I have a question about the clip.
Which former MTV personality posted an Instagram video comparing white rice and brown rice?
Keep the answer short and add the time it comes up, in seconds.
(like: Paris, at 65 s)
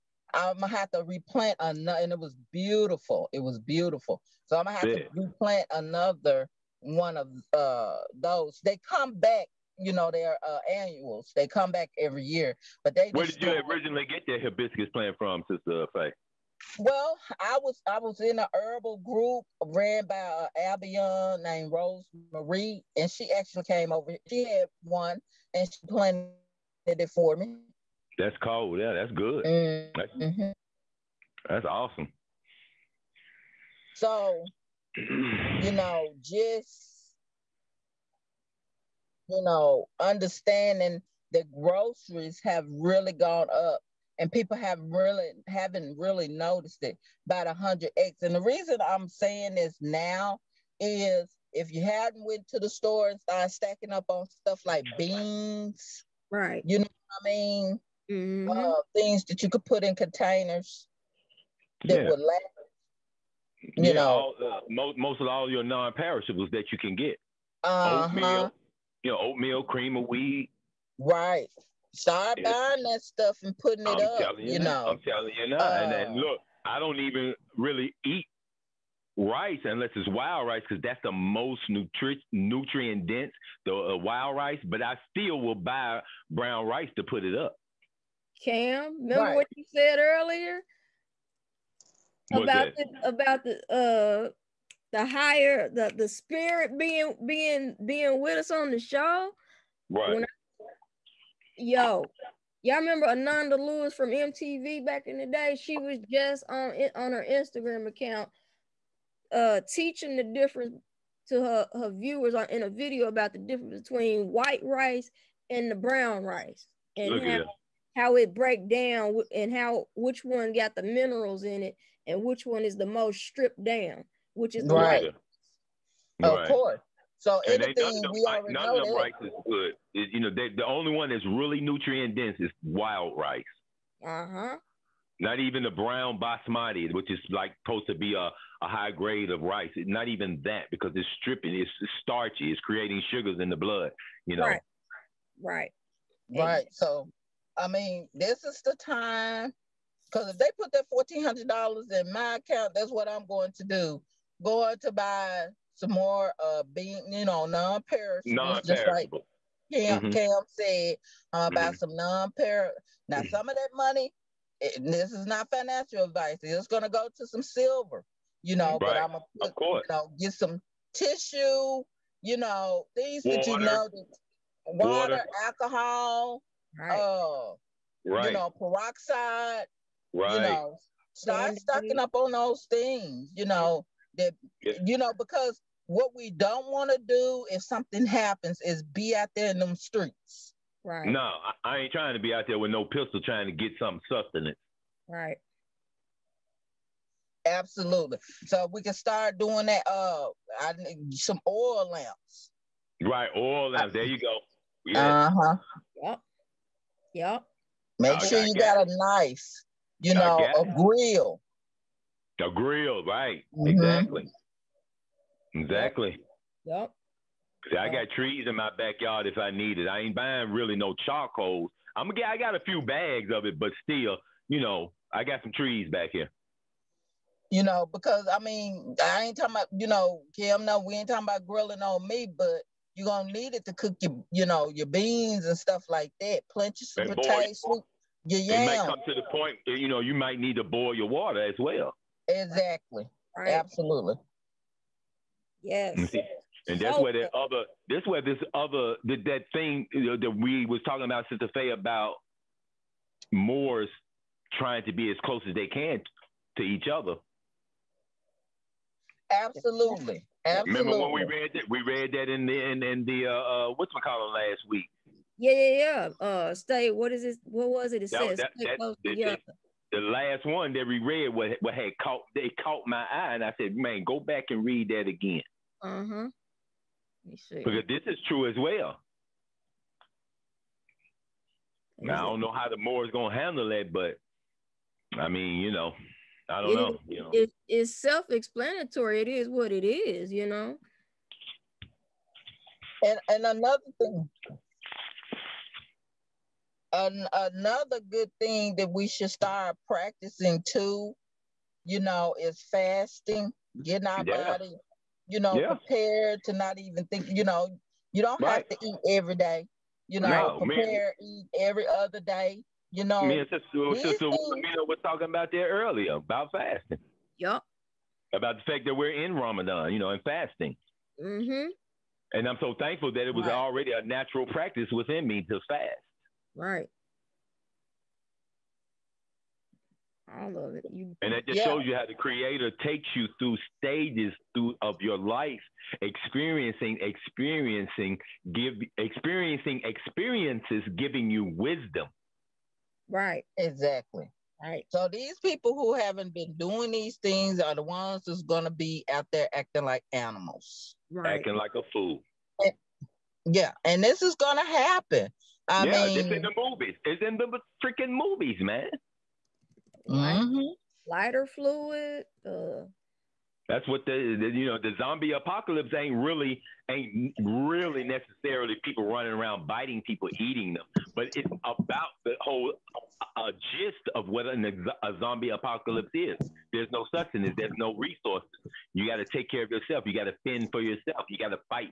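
Ananda Lewis, at 103 s.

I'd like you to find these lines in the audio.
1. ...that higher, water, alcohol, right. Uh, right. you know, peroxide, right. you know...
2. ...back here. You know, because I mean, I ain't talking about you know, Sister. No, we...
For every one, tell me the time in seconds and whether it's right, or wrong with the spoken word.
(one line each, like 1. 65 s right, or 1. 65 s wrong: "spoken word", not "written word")
1. 173 s wrong: "water", not "higher"
2. 225 s wrong: "Kim", not "Sister".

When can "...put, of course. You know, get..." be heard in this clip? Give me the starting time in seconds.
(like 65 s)
169 s.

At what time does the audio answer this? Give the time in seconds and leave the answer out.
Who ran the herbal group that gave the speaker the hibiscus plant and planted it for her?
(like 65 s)
21 s.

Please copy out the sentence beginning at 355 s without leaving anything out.
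I yeah, mean, it's in the movies.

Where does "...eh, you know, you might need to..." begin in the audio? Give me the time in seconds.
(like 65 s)
239 s.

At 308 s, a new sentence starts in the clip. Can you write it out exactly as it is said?
have to eat every day, you know, no, prepare, eat every other day, you know.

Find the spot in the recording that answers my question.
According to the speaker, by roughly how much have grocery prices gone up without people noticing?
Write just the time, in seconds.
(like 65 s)
47 s.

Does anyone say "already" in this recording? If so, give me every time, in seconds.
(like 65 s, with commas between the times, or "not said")
128 s, 323 s.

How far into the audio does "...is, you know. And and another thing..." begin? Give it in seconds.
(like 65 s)
289 s.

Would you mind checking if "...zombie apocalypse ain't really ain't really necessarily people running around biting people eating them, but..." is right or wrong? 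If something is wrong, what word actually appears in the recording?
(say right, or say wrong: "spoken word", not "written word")
right.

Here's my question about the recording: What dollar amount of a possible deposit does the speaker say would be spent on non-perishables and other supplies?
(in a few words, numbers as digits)
$1,400.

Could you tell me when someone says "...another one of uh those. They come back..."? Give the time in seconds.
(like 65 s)
5 s.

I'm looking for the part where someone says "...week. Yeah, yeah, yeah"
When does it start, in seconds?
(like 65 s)
264 s.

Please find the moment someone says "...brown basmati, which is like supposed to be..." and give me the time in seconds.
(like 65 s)
135 s.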